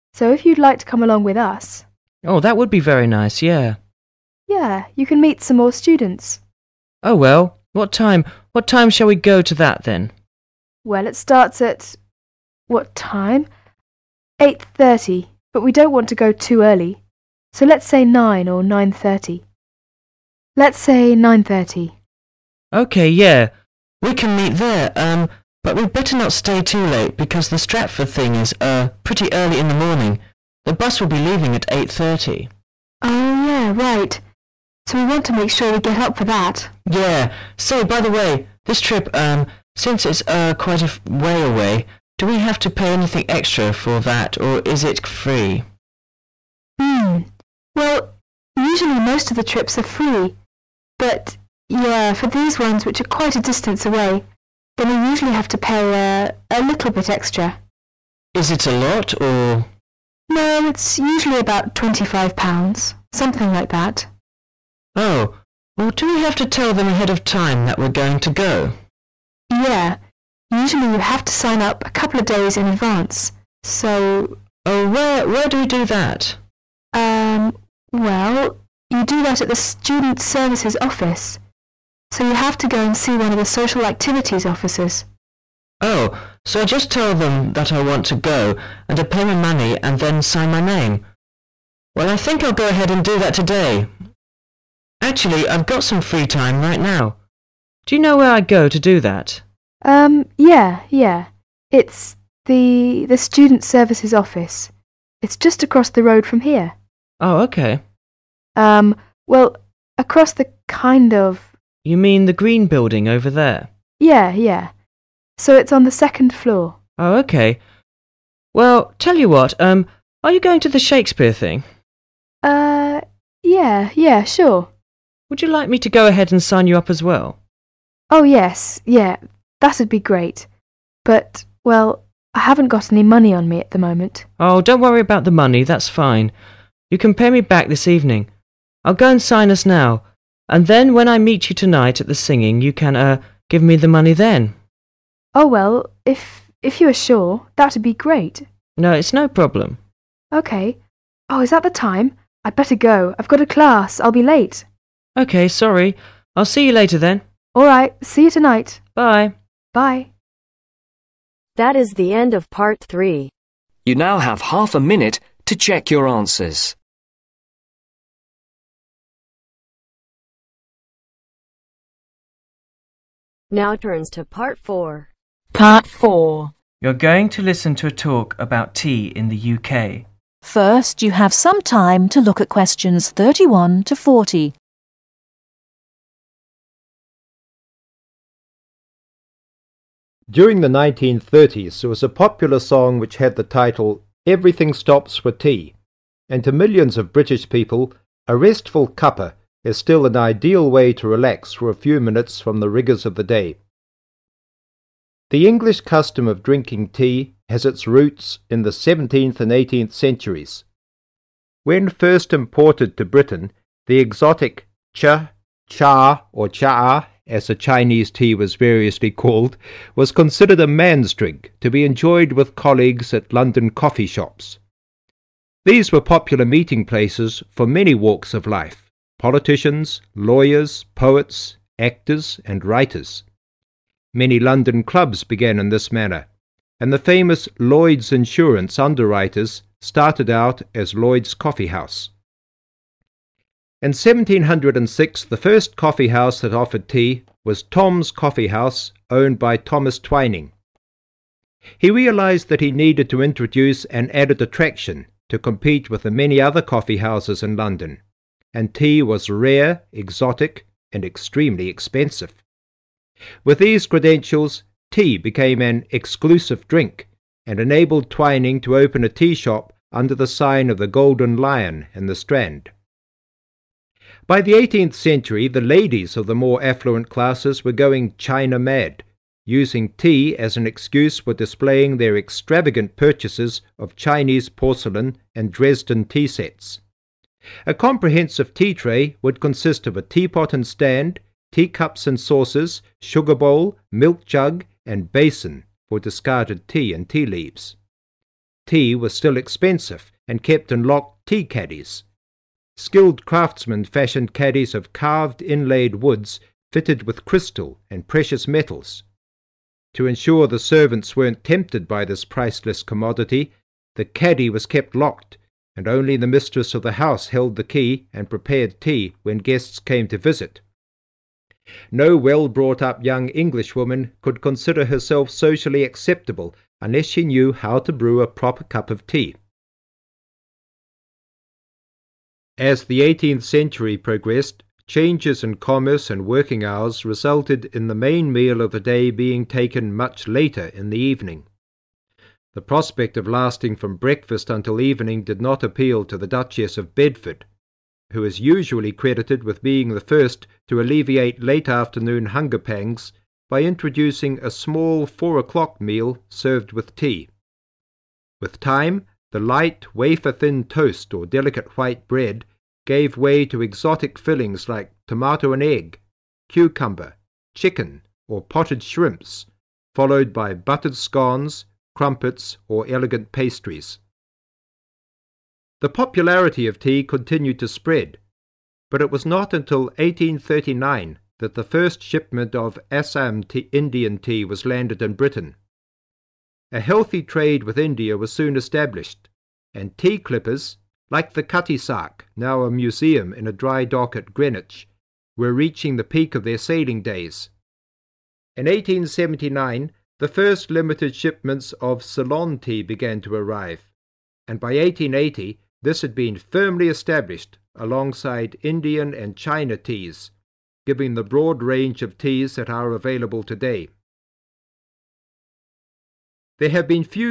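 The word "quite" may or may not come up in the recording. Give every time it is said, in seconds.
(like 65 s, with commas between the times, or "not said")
40 s, 53 s.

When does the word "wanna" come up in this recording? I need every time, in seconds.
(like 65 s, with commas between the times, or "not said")
not said.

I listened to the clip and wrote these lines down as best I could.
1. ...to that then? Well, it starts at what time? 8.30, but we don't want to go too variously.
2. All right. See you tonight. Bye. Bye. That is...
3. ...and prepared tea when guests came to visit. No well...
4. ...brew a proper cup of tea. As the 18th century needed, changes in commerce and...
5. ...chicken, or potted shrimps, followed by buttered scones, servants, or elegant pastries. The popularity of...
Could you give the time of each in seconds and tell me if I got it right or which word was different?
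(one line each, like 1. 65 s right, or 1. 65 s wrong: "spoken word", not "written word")
1. 9 s wrong: "early", not "variously"
2. 157 s right
3. 318 s right
4. 327 s wrong: "progressed", not "needed"
5. 367 s wrong: "crumpets", not "servants".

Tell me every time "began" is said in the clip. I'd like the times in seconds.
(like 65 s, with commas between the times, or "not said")
235 s, 402 s.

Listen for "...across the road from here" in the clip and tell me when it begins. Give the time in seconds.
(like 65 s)
105 s.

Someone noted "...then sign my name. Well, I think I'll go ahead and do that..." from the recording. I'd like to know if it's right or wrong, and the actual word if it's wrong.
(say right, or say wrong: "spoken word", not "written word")
right.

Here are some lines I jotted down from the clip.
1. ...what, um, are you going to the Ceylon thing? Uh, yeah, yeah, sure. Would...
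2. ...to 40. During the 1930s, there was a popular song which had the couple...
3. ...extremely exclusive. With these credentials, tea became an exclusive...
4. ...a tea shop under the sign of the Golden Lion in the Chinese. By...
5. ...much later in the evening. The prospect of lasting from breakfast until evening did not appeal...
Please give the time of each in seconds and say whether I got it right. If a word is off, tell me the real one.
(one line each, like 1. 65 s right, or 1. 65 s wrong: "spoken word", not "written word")
1. 119 s wrong: "Shakespeare", not "Ceylon"
2. 183 s wrong: "title", not "couple"
3. 261 s wrong: "expensive", not "exclusive"
4. 269 s wrong: "Strand", not "Chinese"
5. 339 s right.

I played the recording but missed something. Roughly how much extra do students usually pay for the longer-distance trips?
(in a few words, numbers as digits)
£25.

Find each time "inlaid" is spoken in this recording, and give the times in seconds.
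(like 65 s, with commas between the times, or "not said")
305 s.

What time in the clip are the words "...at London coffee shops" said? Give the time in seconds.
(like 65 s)
223 s.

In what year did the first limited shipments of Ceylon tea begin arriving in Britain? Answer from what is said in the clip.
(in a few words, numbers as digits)
1879.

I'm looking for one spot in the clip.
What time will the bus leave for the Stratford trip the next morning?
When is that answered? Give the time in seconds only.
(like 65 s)
30 s.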